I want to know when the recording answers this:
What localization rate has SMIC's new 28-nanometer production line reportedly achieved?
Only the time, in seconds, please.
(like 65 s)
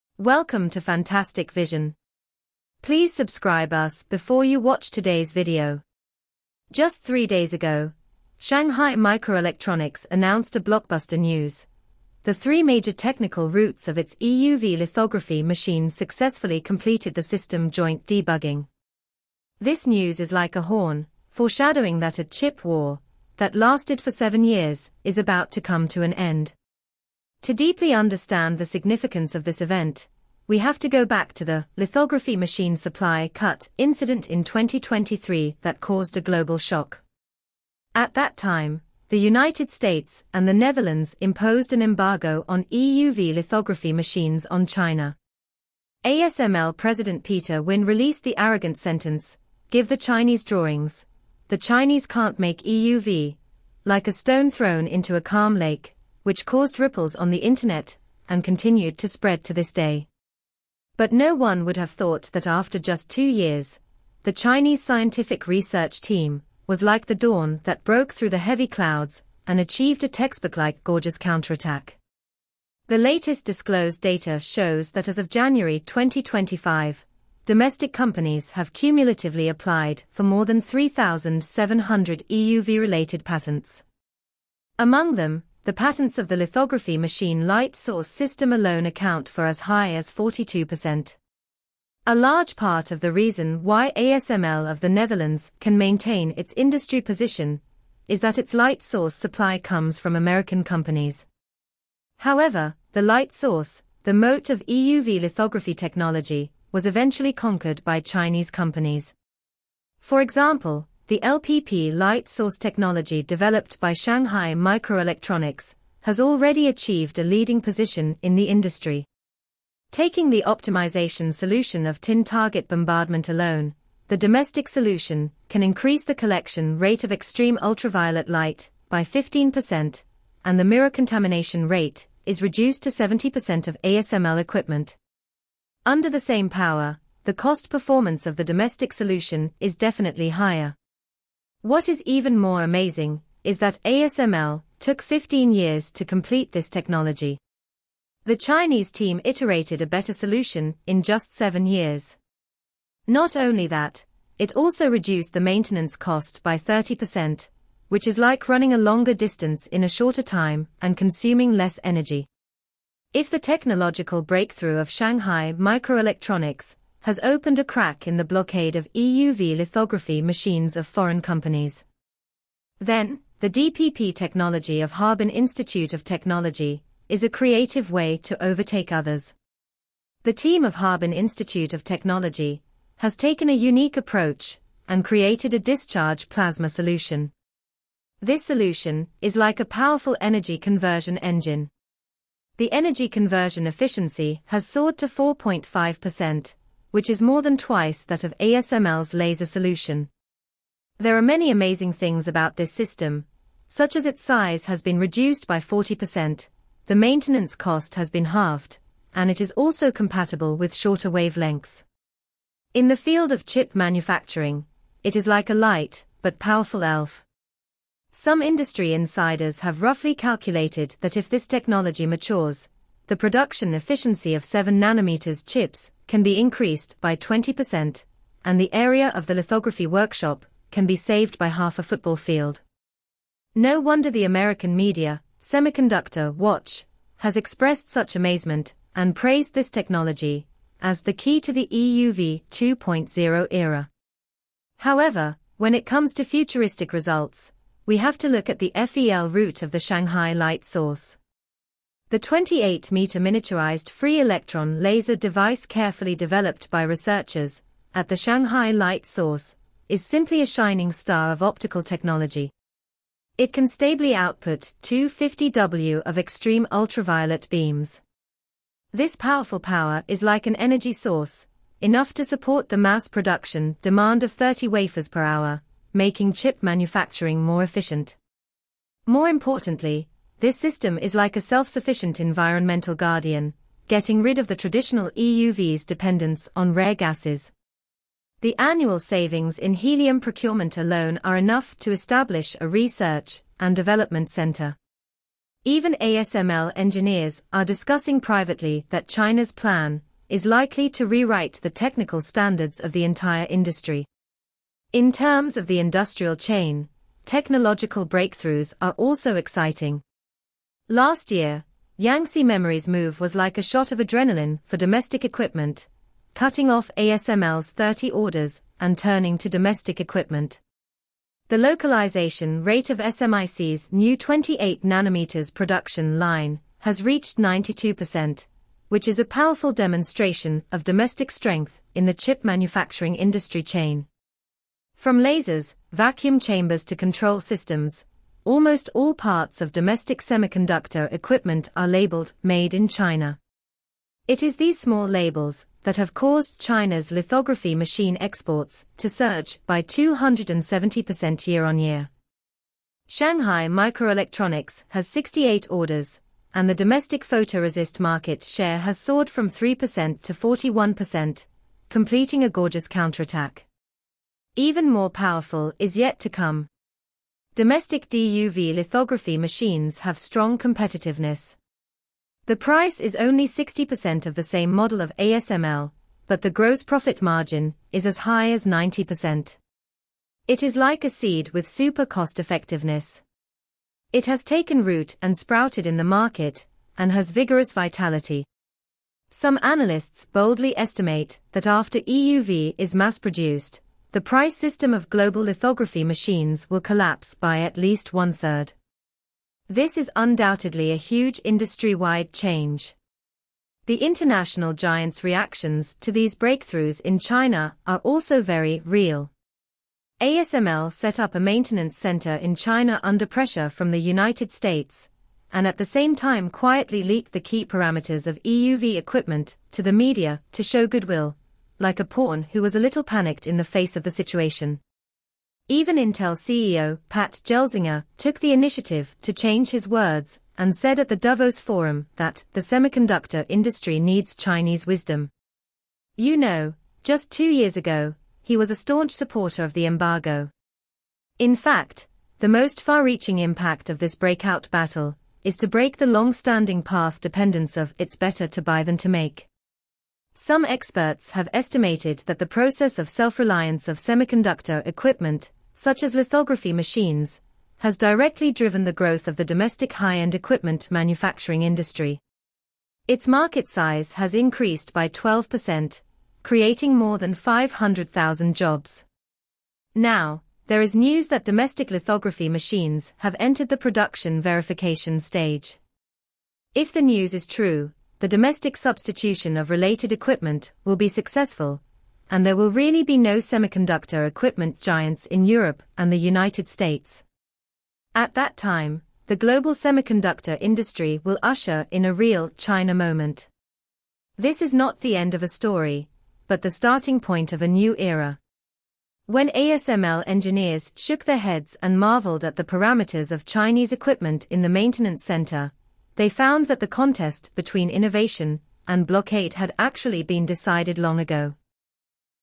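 327 s.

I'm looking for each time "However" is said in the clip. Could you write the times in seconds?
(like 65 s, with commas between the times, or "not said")
102 s, 244 s.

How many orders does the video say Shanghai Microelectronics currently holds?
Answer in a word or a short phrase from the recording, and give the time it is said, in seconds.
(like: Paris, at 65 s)
68, at 355 s.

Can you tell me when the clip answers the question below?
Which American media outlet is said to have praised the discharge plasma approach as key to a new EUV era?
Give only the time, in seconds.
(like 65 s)
235 s.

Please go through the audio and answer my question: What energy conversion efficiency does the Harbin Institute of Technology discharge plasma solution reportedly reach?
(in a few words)
4.5%.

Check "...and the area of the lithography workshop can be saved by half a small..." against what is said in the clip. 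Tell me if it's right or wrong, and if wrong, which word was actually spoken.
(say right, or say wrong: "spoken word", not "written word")
wrong: "football", not "small".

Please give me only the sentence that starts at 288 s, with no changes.
The annual savings in helium procurement alone are enough to establish a research and development center.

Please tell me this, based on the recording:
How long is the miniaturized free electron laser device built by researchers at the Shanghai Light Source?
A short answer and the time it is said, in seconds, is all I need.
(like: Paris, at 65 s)
28 meters, at 252 s.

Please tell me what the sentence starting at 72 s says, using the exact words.
The latest disclosed data shows that as of January 2025, domestic companies have cumulatively applied for more than 3,700 EUV-related patents.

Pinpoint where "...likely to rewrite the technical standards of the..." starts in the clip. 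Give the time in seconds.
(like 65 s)
300 s.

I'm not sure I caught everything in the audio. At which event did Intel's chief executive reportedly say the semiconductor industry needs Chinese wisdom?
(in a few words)
Davos Forum.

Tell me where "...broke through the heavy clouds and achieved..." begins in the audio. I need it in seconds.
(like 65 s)
67 s.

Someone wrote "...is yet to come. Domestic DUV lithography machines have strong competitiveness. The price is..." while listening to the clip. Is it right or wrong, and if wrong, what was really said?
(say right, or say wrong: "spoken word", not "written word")
right.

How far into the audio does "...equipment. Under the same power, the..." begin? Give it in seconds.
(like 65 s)
134 s.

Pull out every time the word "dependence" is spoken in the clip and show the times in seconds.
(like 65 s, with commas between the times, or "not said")
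285 s, 447 s.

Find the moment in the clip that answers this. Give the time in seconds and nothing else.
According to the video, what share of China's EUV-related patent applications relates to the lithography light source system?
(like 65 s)
90 s.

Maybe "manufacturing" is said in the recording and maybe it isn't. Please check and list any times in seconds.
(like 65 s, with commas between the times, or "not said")
213 s, 276 s, 332 s, 460 s.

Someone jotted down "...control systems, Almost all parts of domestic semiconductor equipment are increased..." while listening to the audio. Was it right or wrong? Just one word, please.
wrong.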